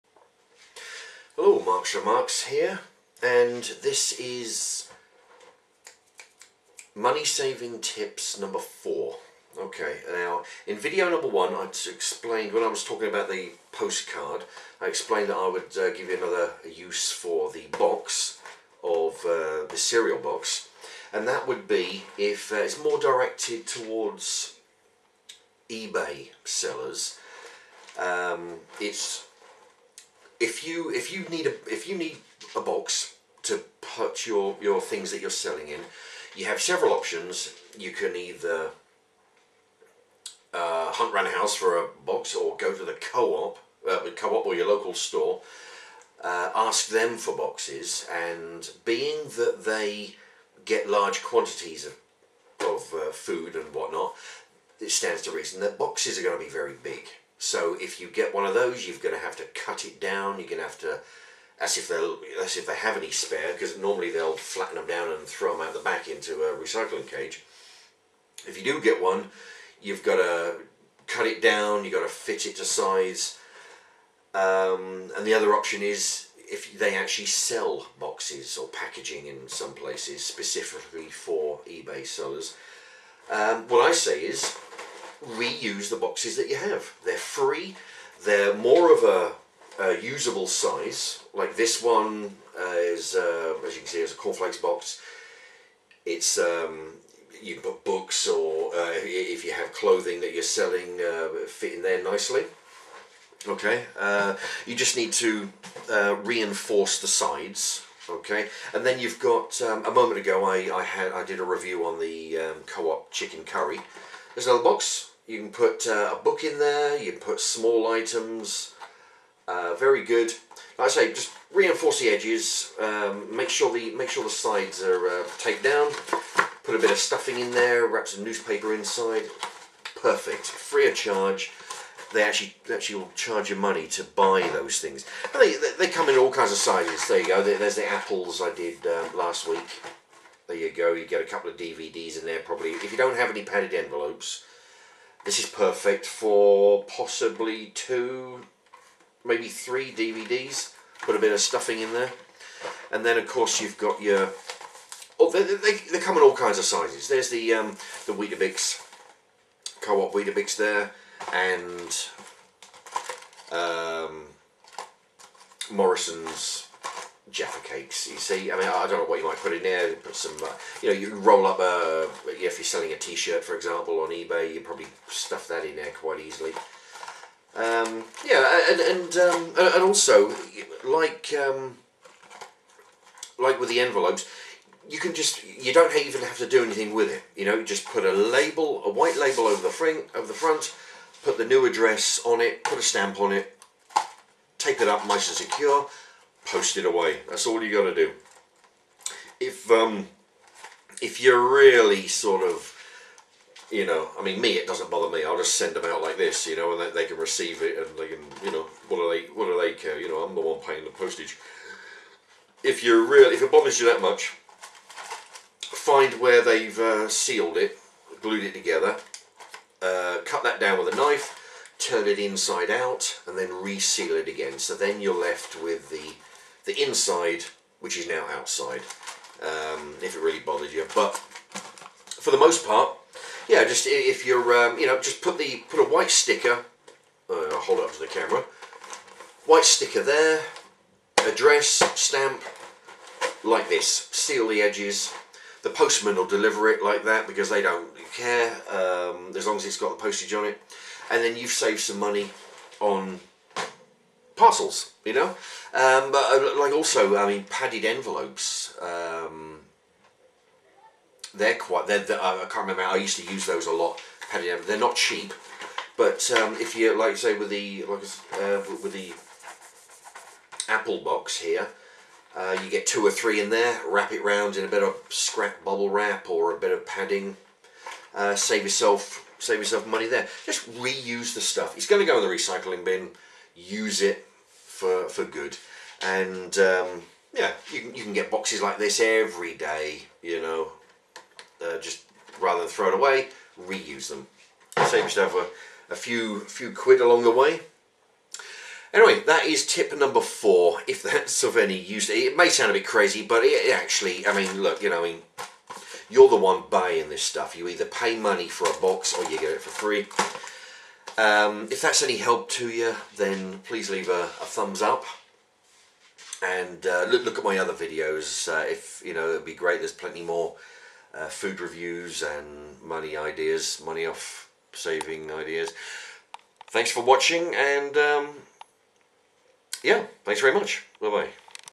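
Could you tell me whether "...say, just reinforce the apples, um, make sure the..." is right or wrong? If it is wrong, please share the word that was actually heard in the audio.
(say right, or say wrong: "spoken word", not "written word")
wrong: "edges", not "apples".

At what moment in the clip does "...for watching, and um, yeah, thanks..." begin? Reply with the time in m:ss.
5:26.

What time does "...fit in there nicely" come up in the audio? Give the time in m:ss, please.
1:41.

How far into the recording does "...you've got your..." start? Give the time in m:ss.
2:33.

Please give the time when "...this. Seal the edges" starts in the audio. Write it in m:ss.
4:03.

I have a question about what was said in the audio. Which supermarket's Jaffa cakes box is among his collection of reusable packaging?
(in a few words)
Morrison's.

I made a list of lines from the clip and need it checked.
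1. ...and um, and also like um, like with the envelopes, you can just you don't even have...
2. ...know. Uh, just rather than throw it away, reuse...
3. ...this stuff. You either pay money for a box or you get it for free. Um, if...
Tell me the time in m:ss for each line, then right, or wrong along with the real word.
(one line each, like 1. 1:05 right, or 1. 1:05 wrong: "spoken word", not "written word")
1. 2:58 right
2. 4:50 right
3. 5:07 right.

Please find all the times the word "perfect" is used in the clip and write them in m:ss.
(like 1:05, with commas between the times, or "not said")
2:10, 2:25.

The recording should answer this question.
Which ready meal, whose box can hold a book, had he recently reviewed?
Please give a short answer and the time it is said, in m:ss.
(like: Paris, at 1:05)
chicken curry, at 1:53.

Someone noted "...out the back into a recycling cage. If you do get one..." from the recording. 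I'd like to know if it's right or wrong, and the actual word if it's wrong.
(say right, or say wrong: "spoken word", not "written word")
right.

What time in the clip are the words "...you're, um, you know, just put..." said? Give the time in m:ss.
3:54.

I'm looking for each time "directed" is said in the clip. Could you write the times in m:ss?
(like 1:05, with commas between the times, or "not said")
0:22.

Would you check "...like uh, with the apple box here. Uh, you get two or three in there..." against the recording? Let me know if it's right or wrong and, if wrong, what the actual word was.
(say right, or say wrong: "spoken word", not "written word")
right.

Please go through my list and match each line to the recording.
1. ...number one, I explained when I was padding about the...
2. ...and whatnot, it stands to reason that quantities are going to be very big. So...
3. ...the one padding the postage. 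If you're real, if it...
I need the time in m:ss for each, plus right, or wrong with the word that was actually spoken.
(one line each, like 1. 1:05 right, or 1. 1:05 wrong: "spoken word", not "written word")
1. 0:11 wrong: "talking", not "padding"
2. 0:53 wrong: "boxes", not "quantities"
3. 3:30 wrong: "paying", not "padding".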